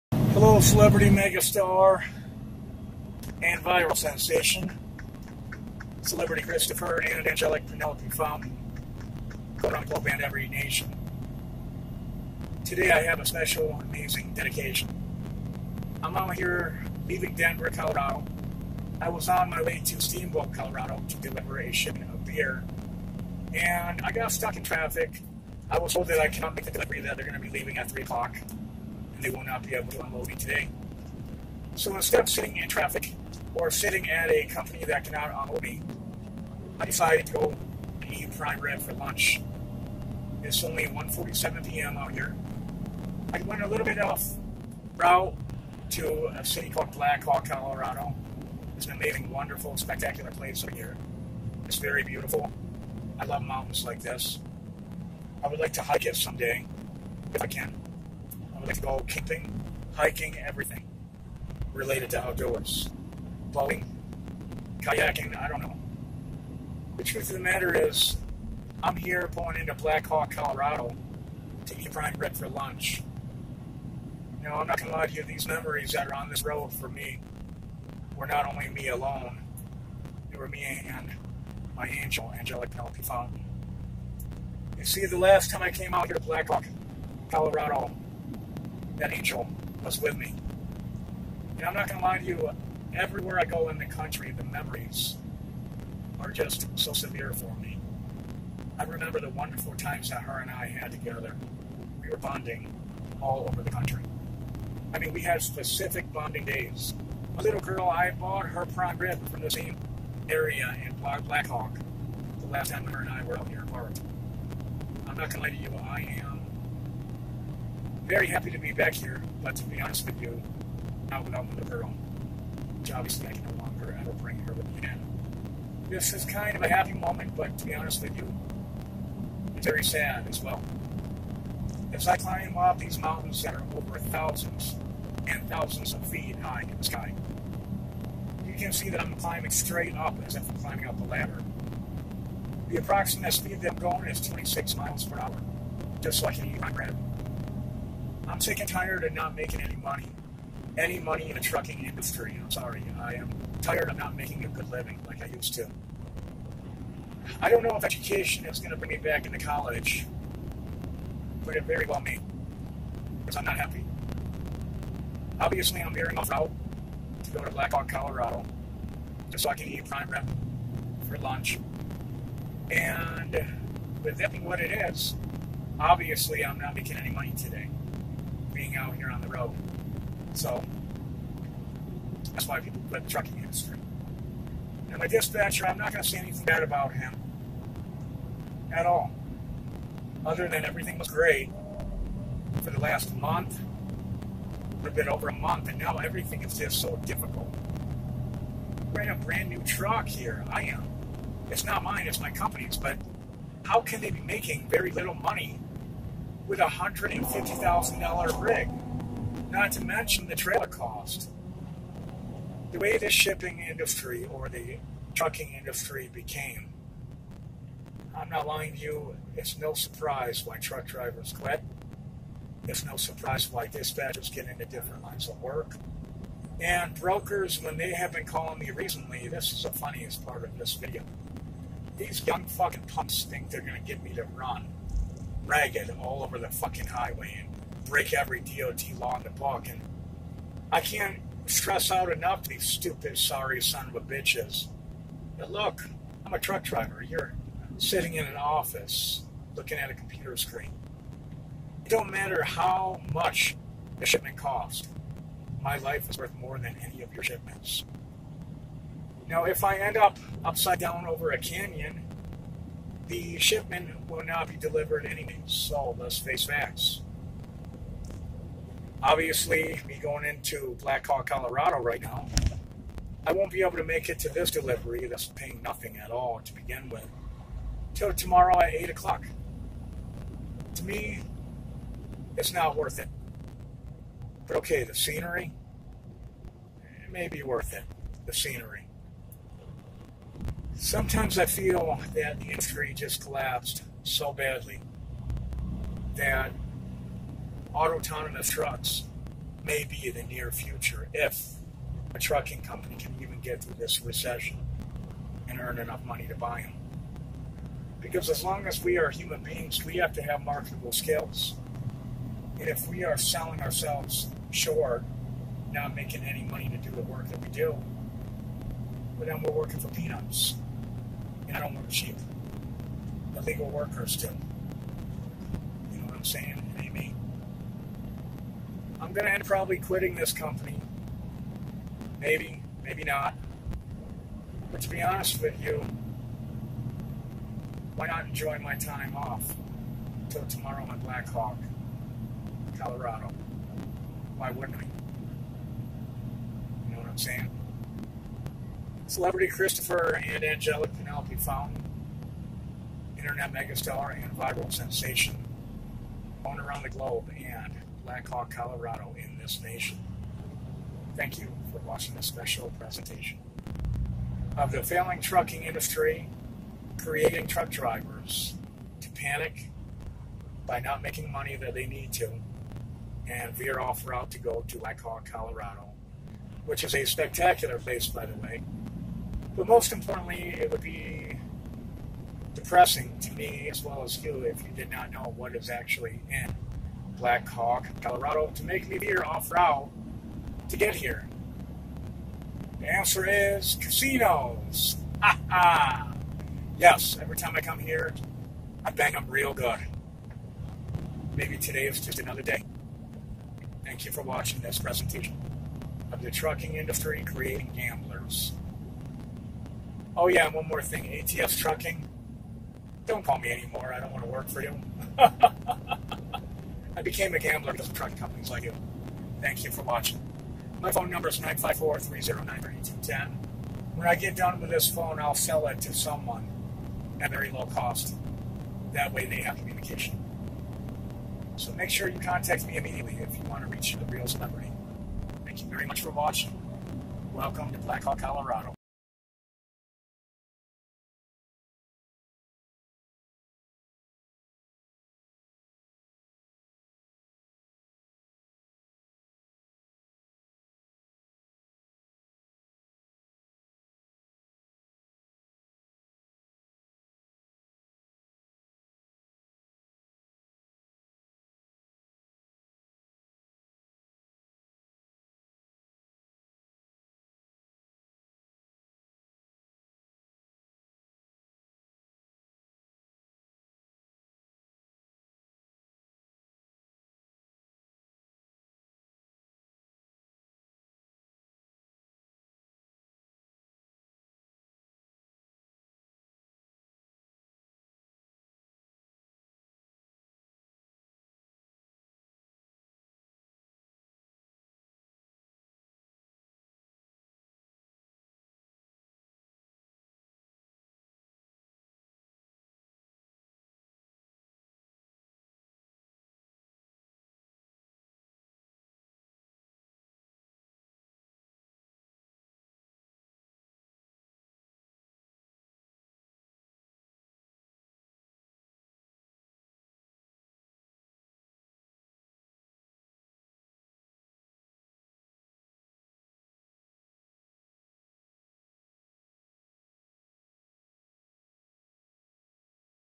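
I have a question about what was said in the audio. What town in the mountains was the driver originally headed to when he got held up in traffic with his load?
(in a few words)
Steamboat, Colorado.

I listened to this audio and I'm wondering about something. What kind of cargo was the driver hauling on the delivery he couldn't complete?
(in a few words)
Beer.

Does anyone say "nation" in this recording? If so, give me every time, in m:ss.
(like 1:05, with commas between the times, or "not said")
0:10, 5:59.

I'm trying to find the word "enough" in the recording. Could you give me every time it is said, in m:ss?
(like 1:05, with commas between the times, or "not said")
4:02, 5:05.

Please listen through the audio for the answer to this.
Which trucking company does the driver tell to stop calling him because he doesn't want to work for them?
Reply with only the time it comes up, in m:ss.
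6:51.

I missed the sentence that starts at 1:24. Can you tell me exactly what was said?
You see, the last time I came out here to Black Hawk, Colorado, that angel was with me.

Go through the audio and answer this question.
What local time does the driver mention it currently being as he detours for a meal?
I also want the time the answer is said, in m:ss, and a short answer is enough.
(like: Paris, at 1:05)
1:47 p.m., at 0:40.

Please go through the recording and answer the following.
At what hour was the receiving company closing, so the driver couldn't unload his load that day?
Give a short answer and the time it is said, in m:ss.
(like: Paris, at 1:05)
3 o'clock, at 0:27.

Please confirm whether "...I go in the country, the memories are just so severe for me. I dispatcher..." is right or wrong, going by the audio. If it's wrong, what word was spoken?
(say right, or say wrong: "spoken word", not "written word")
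wrong: "remember", not "dispatcher".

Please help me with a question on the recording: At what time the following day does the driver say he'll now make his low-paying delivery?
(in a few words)
8 o'clock.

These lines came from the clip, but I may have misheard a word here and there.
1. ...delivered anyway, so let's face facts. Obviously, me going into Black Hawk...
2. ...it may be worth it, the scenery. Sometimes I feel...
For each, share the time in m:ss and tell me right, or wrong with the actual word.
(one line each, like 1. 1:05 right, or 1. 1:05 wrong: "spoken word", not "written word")
1. 4:24 right
2. 4:47 right.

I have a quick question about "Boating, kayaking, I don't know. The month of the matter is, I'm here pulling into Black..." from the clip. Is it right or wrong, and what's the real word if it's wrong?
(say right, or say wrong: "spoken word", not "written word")
wrong: "truth", not "month".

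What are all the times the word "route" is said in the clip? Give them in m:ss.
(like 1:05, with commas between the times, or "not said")
0:44, 6:14, 6:29.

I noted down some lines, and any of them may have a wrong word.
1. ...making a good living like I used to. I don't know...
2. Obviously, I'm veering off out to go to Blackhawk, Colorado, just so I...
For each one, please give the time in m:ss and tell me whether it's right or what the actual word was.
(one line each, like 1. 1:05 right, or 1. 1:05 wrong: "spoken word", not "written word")
1. 2:34 right
2. 2:45 right.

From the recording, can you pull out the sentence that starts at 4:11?
It don't matter how much the shipment costs.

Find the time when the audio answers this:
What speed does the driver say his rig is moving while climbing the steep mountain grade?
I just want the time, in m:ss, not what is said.
2:24.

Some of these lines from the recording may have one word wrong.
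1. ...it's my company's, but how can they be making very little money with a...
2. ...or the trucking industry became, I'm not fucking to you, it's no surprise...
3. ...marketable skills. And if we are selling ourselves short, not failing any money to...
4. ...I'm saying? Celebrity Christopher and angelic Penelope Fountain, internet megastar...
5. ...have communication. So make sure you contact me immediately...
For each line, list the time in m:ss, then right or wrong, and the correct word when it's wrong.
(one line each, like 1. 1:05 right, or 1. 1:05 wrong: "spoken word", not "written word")
1. 3:22 right
2. 3:34 wrong: "lying", not "fucking"
3. 5:10 wrong: "making", not "failing"
4. 5:47 right
5. 7:09 right.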